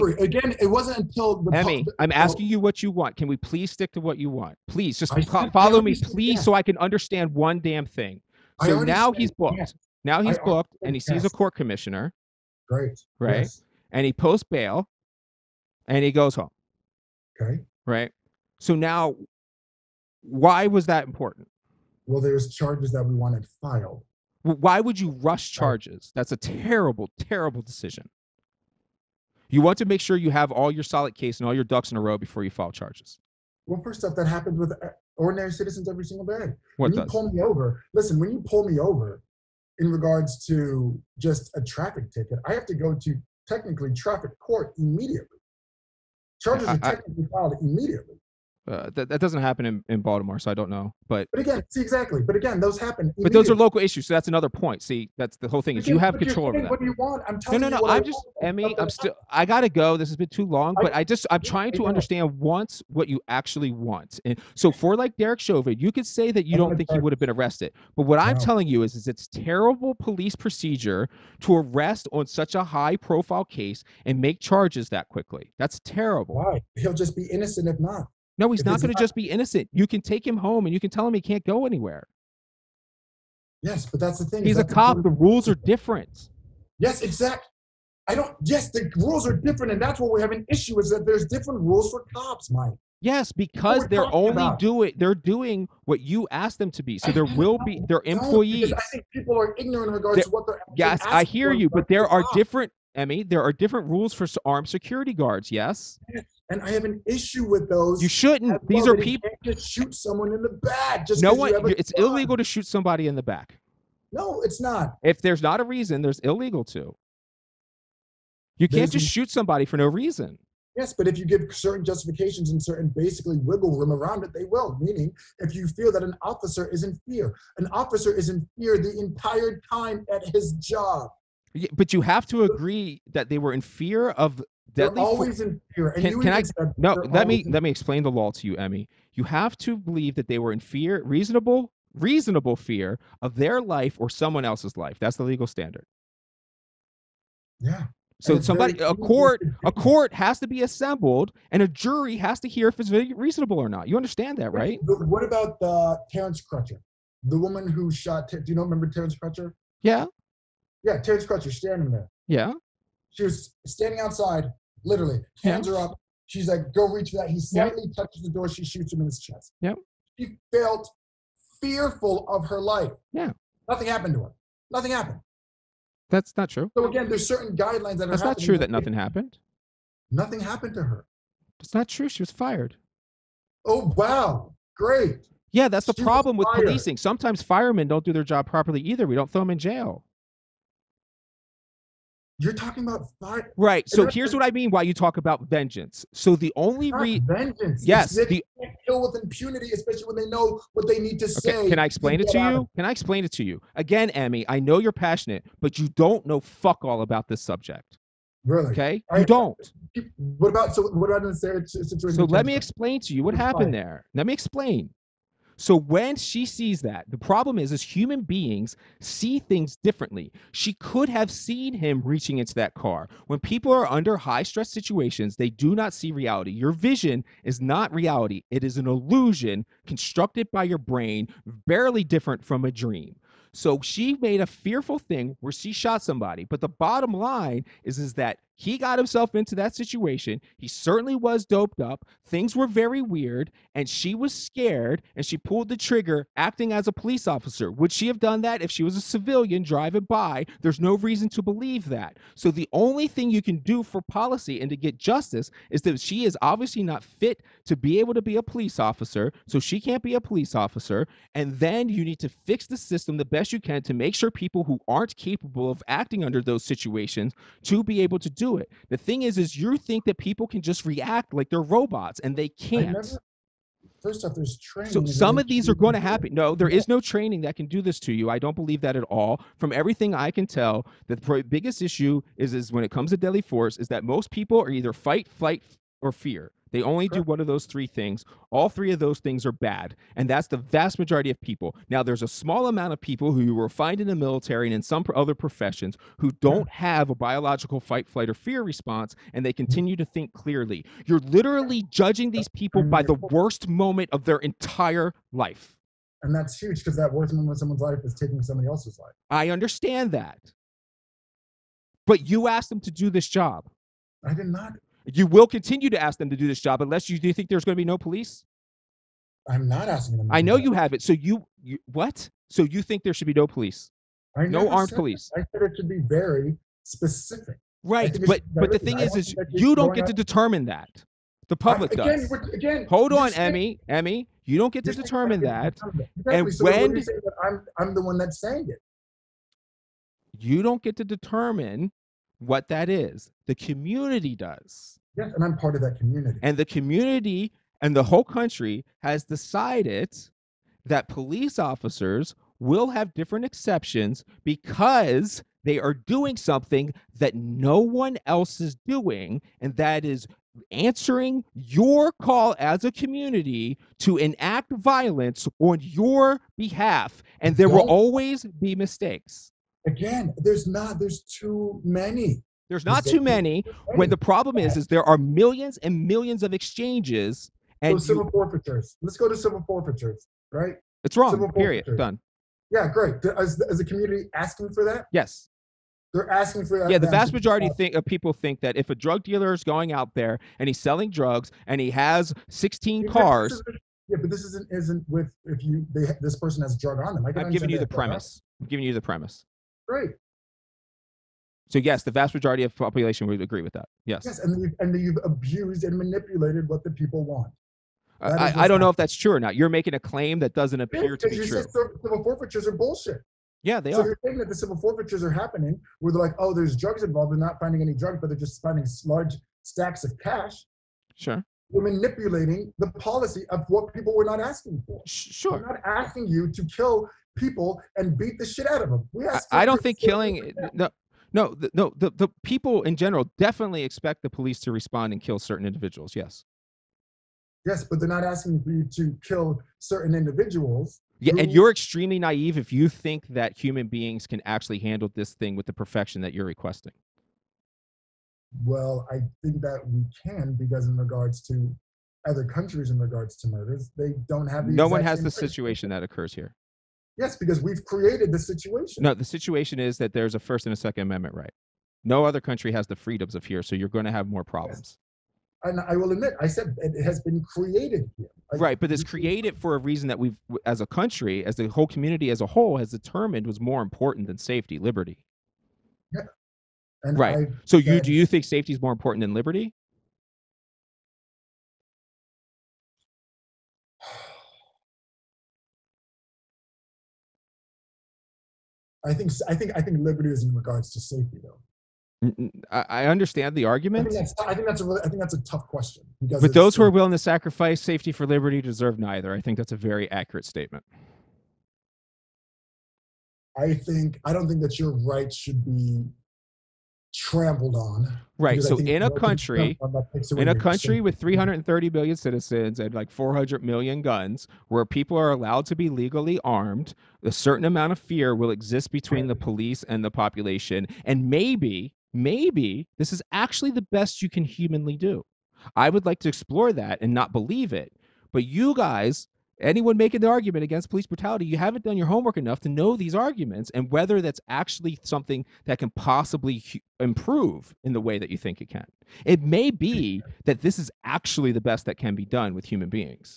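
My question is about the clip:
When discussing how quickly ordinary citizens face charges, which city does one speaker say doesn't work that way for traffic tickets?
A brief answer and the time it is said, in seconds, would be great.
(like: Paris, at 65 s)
Baltimore, at 50 s.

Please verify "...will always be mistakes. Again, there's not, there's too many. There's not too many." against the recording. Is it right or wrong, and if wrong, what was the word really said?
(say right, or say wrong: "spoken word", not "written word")
right.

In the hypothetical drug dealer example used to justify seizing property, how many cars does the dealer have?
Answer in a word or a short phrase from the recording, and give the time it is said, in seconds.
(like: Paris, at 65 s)
16, at 392 s.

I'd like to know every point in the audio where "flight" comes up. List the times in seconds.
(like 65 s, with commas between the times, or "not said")
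285 s, 298 s.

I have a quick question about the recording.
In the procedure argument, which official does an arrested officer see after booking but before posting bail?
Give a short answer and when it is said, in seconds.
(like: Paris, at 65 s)
Court commissioner, at 11 s.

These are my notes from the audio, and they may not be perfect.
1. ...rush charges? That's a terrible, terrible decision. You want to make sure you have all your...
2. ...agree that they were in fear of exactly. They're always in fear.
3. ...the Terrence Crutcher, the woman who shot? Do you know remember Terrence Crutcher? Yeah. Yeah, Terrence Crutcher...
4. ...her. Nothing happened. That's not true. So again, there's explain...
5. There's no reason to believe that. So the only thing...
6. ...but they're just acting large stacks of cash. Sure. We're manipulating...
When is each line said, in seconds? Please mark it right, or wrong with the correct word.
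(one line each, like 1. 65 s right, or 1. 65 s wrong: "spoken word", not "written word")
1. 25 s right
2. 132 s wrong: "deadly", not "exactly"
3. 155 s right
4. 174 s wrong: "certain", not "explain"
5. 250 s right
6. 418 s wrong: "finding", not "acting".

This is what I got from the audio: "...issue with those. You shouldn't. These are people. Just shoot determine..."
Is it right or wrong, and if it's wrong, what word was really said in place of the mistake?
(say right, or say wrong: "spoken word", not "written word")
wrong: "someone", not "determine".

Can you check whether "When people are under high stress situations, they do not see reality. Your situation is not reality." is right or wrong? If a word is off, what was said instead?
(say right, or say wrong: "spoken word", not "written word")
wrong: "vision", not "situation".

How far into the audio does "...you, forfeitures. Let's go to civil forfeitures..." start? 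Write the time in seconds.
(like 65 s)
378 s.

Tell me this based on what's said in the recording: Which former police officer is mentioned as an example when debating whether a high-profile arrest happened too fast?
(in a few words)
Derek Chauvin.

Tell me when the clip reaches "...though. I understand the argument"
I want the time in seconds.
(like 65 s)
491 s.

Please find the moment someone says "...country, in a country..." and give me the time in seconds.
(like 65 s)
509 s.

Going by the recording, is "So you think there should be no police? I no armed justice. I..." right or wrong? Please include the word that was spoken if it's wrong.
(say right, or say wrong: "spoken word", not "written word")
wrong: "police", not "justice".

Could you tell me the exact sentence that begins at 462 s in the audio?
No other country has the freedoms of here, so you're going to have more problems.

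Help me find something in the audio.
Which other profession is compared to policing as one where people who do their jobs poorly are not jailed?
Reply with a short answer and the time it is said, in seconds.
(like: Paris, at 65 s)
Firemen, at 187 s.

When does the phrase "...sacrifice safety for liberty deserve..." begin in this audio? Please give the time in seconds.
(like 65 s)
497 s.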